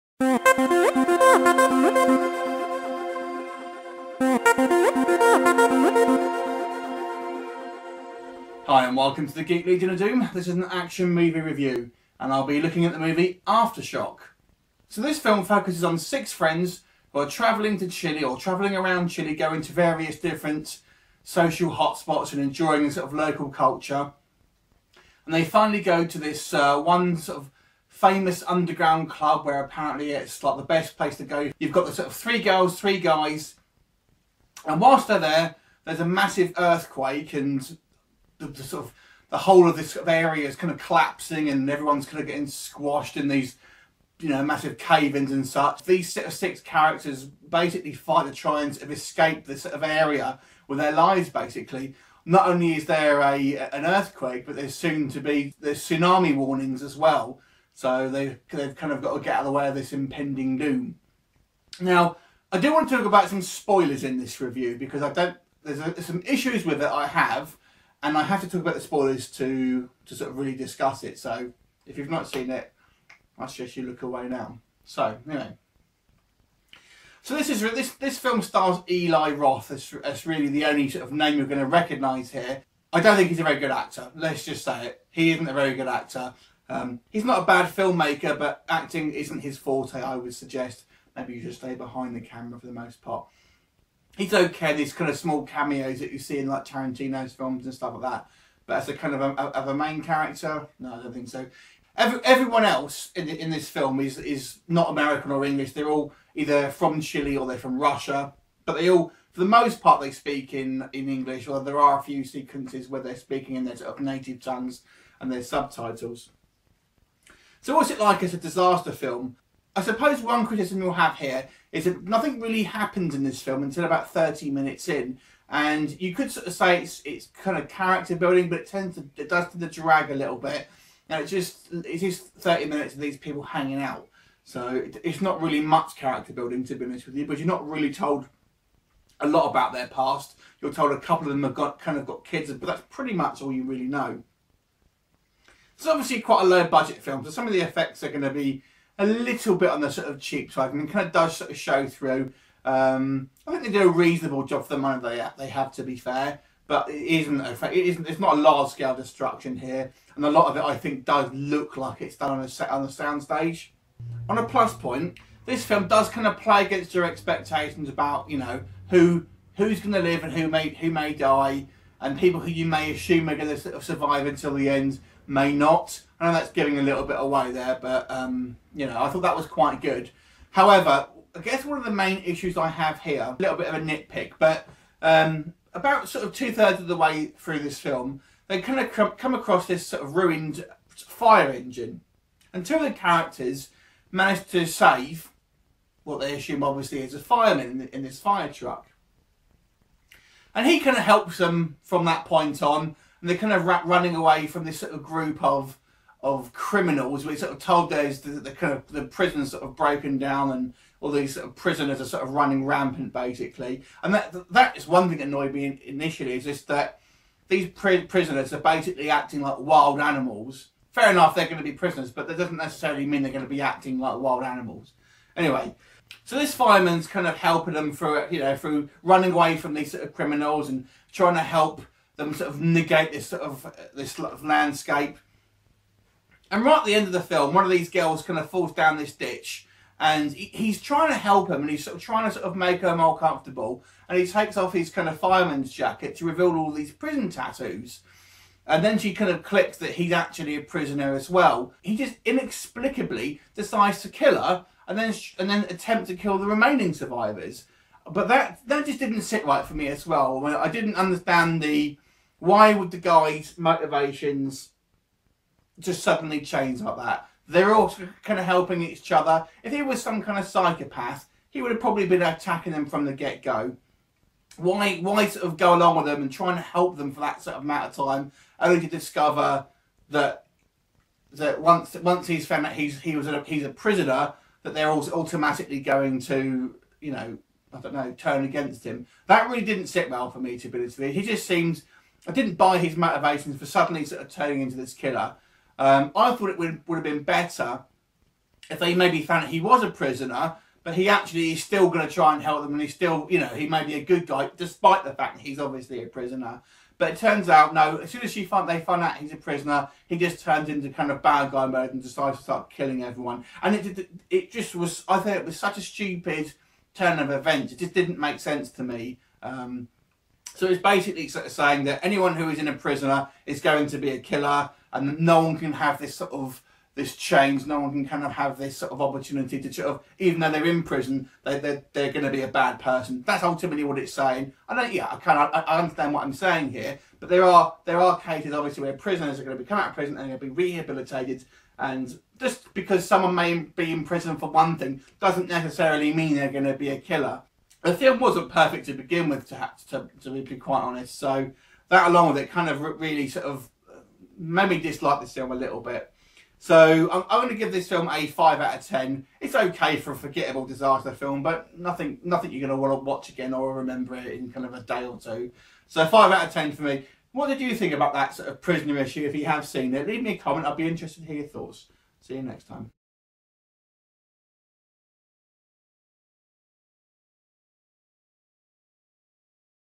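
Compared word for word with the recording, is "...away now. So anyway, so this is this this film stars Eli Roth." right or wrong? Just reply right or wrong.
right.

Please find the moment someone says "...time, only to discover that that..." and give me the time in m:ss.
4:38.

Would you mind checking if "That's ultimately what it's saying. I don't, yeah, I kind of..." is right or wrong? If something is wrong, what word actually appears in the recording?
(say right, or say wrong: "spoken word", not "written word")
right.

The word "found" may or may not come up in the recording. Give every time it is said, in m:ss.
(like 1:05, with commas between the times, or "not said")
4:42, 4:59.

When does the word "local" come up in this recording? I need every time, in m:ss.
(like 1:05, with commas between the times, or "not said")
0:23.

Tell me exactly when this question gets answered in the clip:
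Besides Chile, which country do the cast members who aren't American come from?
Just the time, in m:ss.
1:47.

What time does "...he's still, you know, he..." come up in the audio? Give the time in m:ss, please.
5:02.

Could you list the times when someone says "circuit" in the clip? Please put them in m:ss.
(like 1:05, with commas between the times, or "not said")
not said.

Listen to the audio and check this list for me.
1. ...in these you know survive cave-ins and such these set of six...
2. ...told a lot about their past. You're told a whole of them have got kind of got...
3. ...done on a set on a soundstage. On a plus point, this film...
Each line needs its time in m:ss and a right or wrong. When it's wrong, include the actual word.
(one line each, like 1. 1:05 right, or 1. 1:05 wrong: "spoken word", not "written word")
1. 0:43 wrong: "massive", not "survive"
2. 2:17 wrong: "couple", not "whole"
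3. 2:42 right.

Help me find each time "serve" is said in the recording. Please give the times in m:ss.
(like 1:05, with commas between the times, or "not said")
not said.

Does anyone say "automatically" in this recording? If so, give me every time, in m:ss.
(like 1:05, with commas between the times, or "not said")
4:45.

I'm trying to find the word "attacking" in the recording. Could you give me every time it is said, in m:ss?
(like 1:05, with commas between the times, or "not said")
4:32.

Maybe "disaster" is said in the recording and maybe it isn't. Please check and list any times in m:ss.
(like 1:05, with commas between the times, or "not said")
1:58, 6:00.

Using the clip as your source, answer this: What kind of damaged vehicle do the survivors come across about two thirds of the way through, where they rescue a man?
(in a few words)
fire engine.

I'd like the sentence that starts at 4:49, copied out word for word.
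That really didn't sit well for me to be honest with you.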